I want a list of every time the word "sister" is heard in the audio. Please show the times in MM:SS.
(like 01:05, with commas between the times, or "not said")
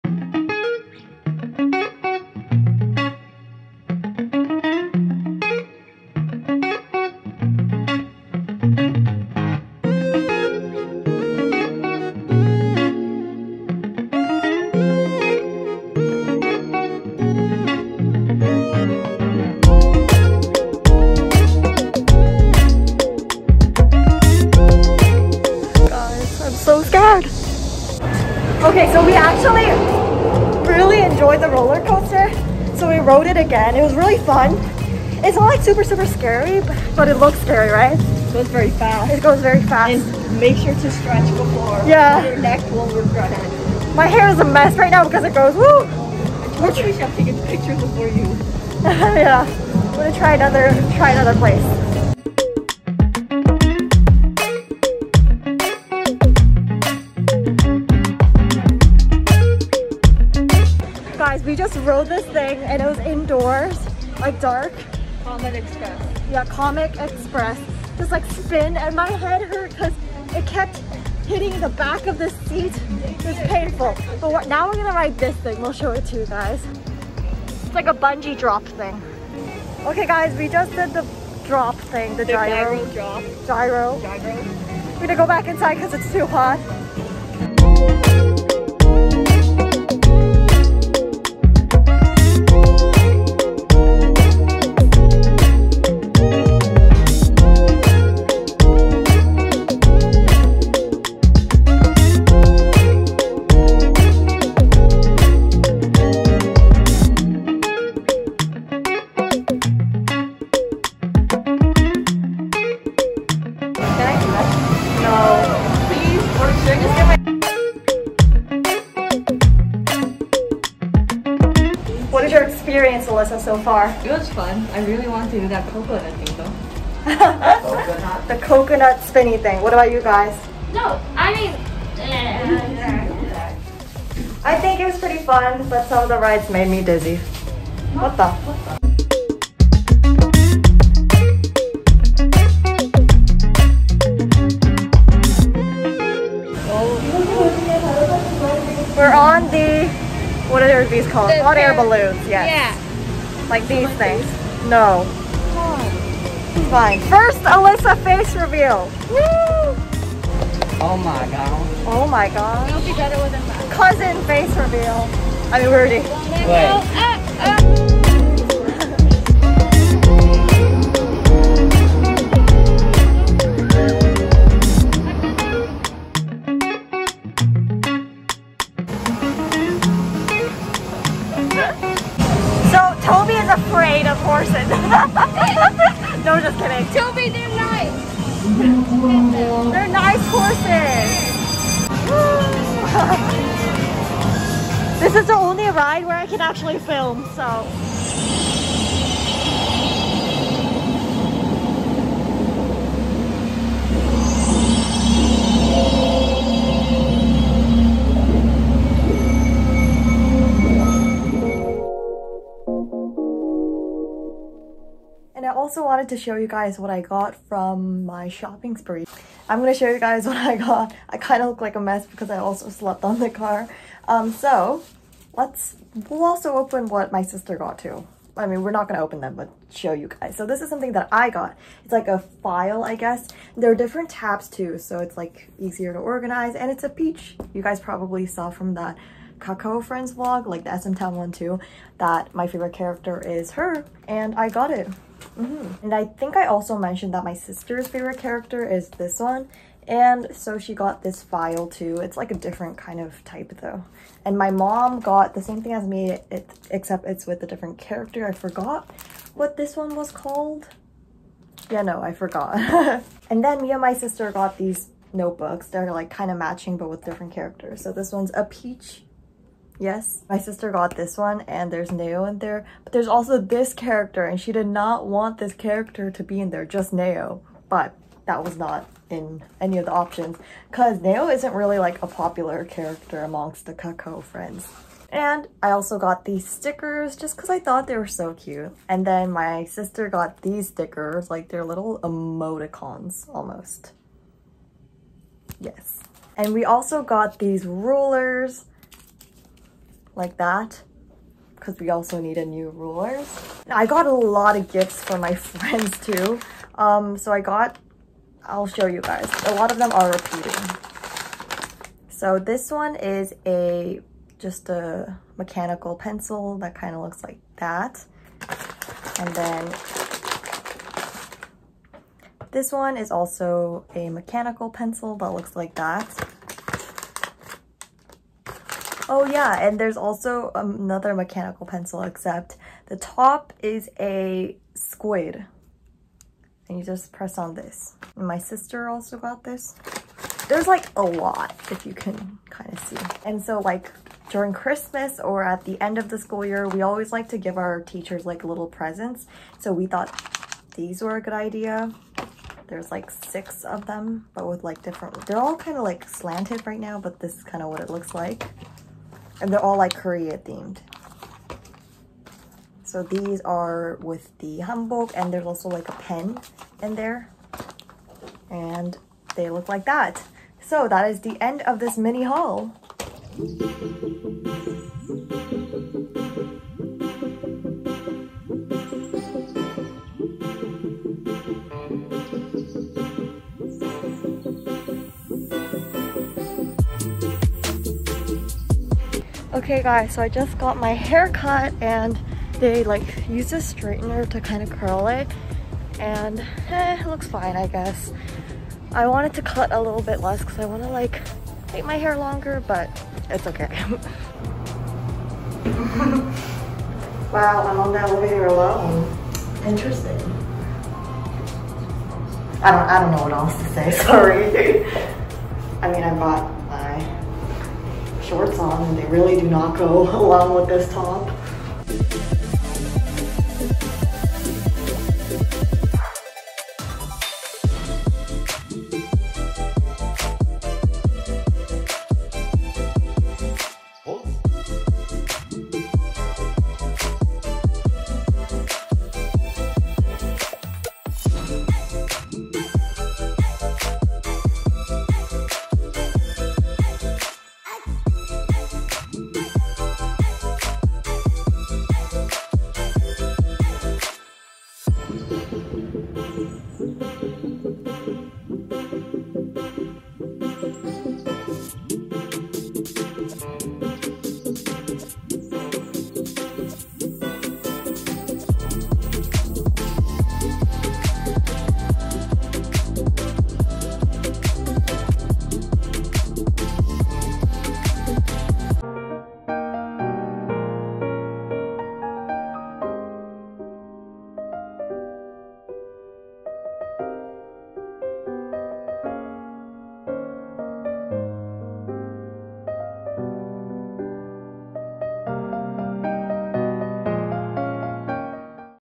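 03:47, 04:07, 04:23, 04:30, 04:49, 05:38.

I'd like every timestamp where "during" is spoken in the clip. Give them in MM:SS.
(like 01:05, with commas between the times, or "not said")
05:44.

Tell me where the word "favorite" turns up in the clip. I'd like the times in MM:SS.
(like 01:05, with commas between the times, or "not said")
04:02, 04:07.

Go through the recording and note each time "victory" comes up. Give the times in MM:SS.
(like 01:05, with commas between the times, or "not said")
not said.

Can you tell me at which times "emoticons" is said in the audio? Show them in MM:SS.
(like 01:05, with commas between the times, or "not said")
04:52.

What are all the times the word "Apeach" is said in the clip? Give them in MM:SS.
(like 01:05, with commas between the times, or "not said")
03:56, 04:28.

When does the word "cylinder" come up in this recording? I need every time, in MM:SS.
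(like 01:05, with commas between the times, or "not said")
not said.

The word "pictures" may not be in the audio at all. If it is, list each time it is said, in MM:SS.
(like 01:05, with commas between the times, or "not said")
00:47.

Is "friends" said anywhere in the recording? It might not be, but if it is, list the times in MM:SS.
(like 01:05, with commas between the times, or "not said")
03:59, 04:44, 05:05.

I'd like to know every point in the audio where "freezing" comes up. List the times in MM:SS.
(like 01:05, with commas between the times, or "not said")
not said.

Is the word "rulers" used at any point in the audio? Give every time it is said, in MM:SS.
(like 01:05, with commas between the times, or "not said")
04:57, 05:02.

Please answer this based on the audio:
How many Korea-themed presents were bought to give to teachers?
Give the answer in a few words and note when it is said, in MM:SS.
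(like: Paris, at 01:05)
6, at 05:53.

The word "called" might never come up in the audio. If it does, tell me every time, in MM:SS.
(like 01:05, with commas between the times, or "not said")
02:31, 04:20.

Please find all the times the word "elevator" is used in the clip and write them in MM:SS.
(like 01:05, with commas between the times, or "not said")
06:48.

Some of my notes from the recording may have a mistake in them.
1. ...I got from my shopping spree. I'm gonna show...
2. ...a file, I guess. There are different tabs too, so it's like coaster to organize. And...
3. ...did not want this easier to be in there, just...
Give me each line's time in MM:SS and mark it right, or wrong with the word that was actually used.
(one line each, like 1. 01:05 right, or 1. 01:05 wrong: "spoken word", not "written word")
1. 03:36 right
2. 03:52 wrong: "easier", not "coaster"
3. 04:34 wrong: "character", not "easier".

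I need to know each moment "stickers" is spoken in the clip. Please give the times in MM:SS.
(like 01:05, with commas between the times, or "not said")
04:46, 04:50.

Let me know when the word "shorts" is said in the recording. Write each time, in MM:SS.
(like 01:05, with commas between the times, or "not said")
06:58.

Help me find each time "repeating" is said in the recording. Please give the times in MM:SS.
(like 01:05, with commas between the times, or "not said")
05:10.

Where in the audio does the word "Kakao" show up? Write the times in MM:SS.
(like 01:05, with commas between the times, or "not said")
03:59, 04:43.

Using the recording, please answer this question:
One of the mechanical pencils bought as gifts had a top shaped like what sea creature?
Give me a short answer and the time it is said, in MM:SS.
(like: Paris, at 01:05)
A squid, at 05:34.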